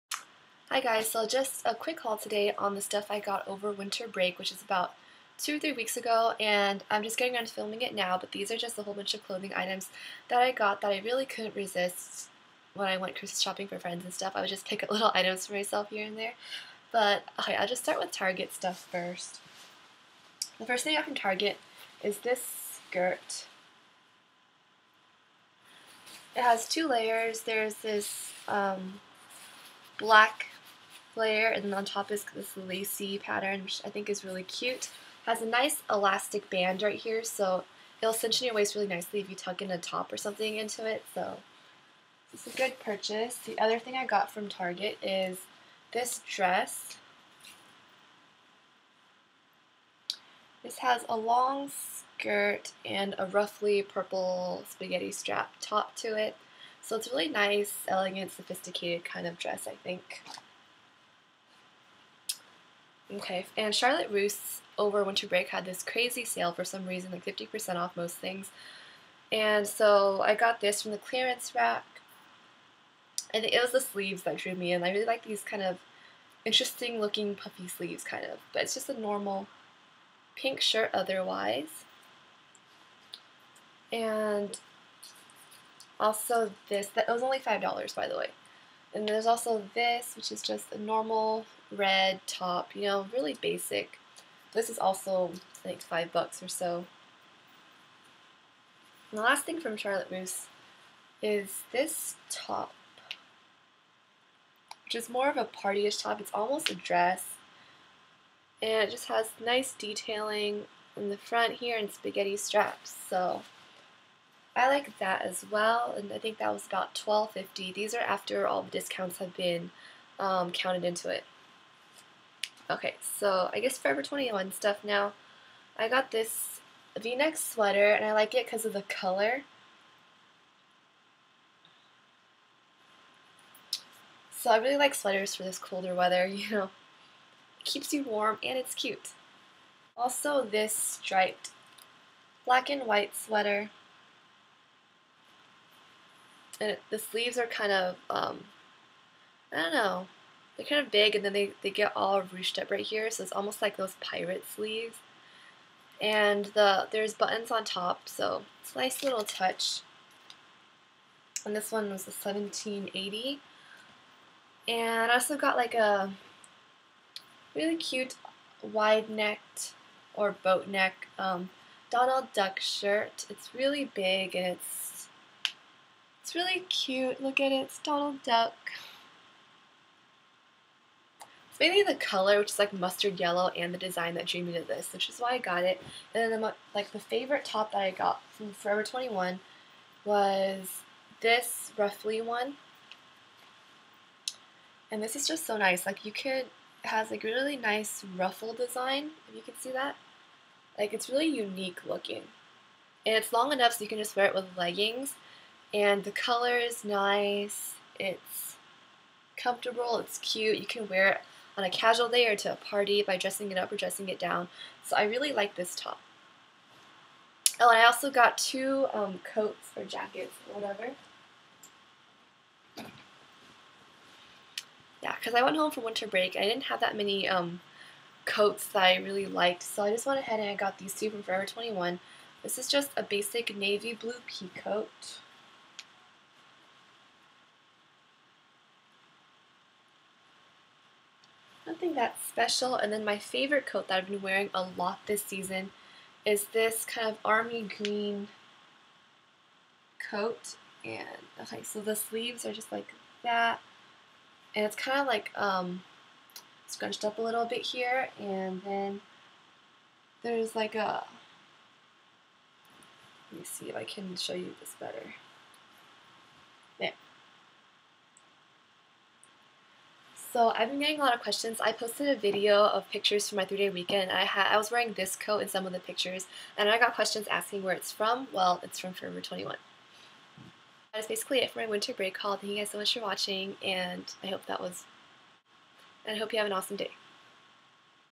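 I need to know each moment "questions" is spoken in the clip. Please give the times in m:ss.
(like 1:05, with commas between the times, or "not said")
4:31, 4:36.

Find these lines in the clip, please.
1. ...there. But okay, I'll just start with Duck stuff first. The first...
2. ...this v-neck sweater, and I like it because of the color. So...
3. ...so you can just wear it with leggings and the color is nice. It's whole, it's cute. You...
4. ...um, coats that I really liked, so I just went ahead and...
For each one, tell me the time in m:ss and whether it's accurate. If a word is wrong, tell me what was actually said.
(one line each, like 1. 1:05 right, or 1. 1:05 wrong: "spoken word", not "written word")
1. 0:16 wrong: "Target", not "Duck"
2. 2:06 right
3. 3:23 wrong: "comfortable", not "whole"
4. 3:47 right.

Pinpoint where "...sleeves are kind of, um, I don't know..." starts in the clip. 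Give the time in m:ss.
2:26.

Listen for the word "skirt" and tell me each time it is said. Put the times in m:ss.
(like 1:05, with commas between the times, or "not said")
0:22, 0:51.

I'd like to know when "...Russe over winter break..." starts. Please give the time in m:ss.
1:04.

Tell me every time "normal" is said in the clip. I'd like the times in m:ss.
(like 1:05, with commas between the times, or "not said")
1:18, 1:30.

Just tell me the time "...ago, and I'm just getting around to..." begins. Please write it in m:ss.
0:05.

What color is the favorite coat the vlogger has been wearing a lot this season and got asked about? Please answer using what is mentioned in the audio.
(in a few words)
army green.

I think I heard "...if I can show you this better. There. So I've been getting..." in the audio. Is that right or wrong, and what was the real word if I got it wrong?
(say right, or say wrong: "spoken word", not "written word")
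right.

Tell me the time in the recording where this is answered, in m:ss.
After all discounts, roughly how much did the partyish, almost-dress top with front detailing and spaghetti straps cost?
1:56.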